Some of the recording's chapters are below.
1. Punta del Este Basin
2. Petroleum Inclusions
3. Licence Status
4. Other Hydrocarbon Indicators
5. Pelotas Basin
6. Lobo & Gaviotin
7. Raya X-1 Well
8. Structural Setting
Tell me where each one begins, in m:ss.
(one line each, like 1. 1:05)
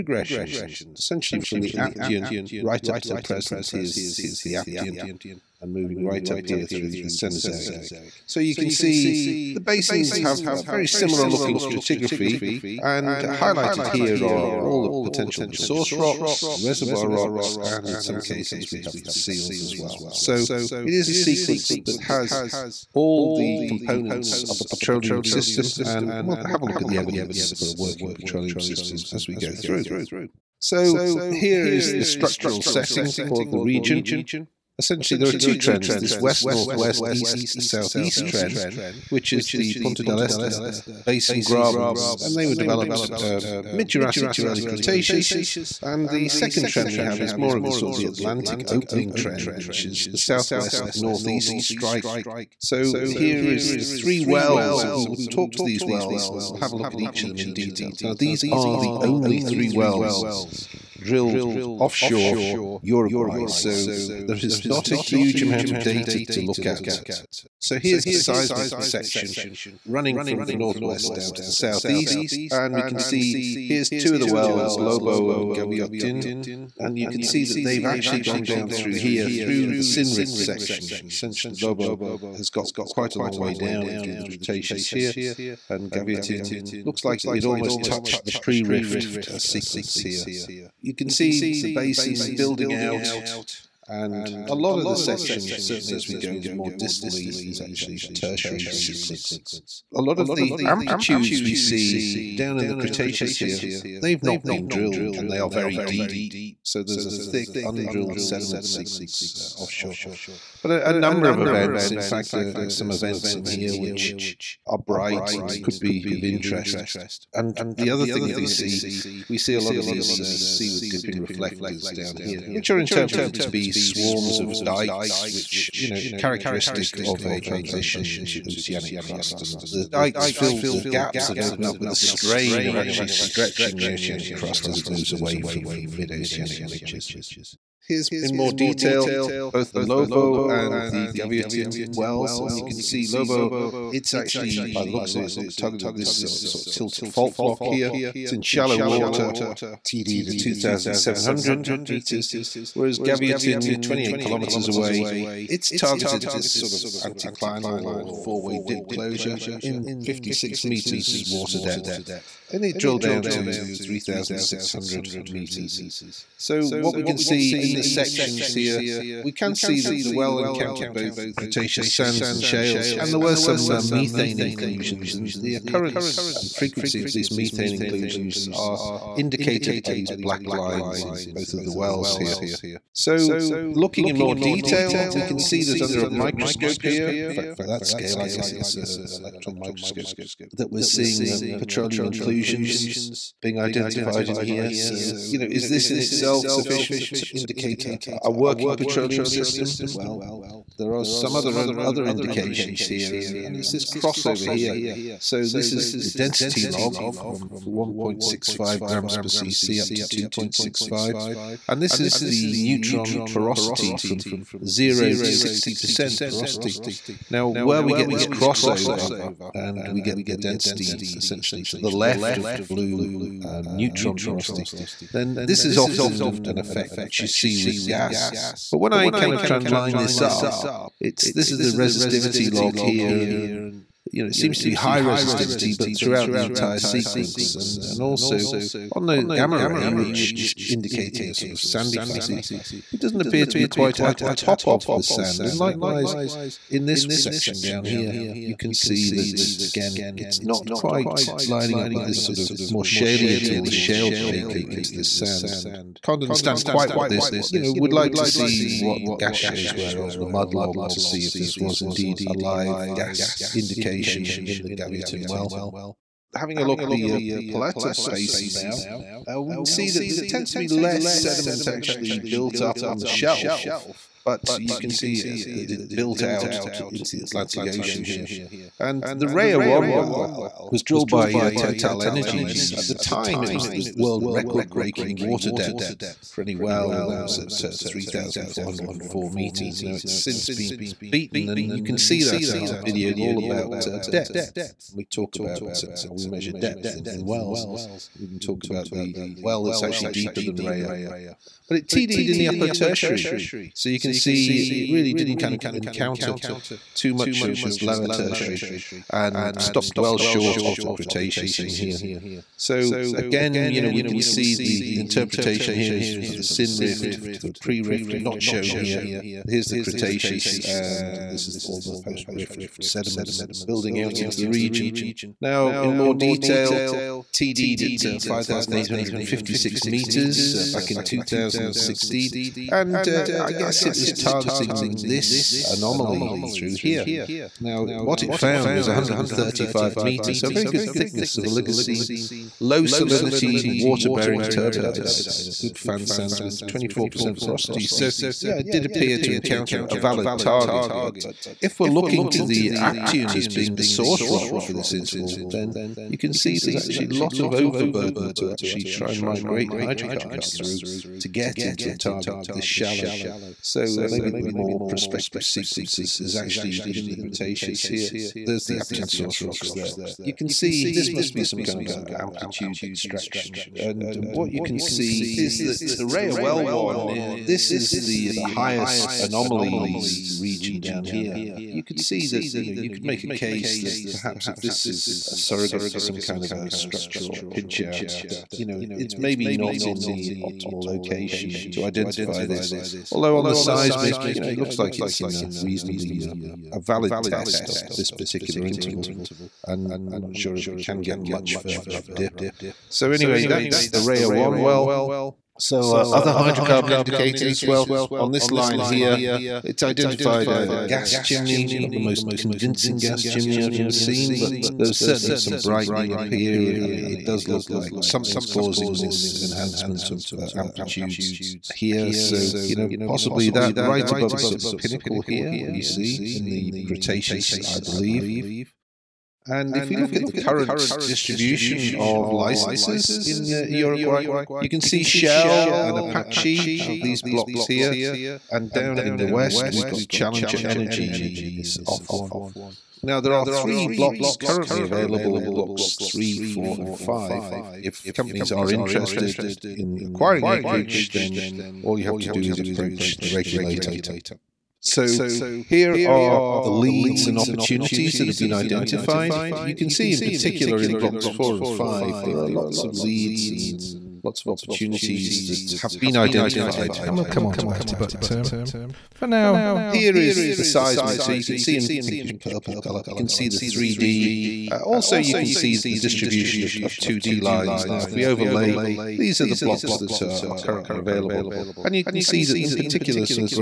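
1. 1:10
2. 3:07
3. 7:12
4. 6:47
5. 4:28
6. 2:21
7. 5:28
8. 0:33.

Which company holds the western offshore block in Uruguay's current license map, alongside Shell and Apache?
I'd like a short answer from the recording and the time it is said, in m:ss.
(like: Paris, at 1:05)
Challenger Energy, at 7:20.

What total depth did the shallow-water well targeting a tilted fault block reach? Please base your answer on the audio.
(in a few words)
2,700 meters.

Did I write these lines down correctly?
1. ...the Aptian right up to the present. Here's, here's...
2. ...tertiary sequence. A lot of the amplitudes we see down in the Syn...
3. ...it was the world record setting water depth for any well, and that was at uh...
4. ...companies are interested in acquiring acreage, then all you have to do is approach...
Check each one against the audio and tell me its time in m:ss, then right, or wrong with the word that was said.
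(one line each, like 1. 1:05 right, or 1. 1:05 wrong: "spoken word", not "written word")
1. 0:01 right
2. 1:38 wrong: "Cretaceous", not "Syn"
3. 4:43 wrong: "breaking", not "setting"
4. 7:28 right.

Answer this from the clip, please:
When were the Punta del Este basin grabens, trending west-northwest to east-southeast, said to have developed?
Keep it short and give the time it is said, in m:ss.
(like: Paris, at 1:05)
Mid Jurassic to early Cretaceous, at 0:43.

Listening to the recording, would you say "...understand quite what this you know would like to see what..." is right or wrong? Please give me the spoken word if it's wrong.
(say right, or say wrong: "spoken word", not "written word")
right.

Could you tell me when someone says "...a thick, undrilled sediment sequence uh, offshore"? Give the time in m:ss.
1:47.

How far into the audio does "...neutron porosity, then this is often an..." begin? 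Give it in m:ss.
3:43.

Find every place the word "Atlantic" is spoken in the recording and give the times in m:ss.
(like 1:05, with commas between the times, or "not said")
0:48, 4:37.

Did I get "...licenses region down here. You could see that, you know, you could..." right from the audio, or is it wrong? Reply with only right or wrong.
wrong.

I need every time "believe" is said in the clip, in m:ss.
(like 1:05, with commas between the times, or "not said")
7:07.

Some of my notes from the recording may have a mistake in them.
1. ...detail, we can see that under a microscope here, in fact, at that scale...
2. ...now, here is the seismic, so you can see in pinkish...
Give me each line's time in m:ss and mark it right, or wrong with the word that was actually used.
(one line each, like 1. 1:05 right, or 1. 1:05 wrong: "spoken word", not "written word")
1. 3:04 right
2. 7:49 right.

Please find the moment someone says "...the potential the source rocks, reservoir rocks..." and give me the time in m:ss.
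0:14.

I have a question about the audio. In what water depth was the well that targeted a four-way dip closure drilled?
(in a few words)
56 meters.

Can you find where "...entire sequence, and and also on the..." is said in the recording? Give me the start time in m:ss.
3:56.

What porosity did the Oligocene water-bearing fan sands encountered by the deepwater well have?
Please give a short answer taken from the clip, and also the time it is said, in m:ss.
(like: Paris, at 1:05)
24%, at 5:46.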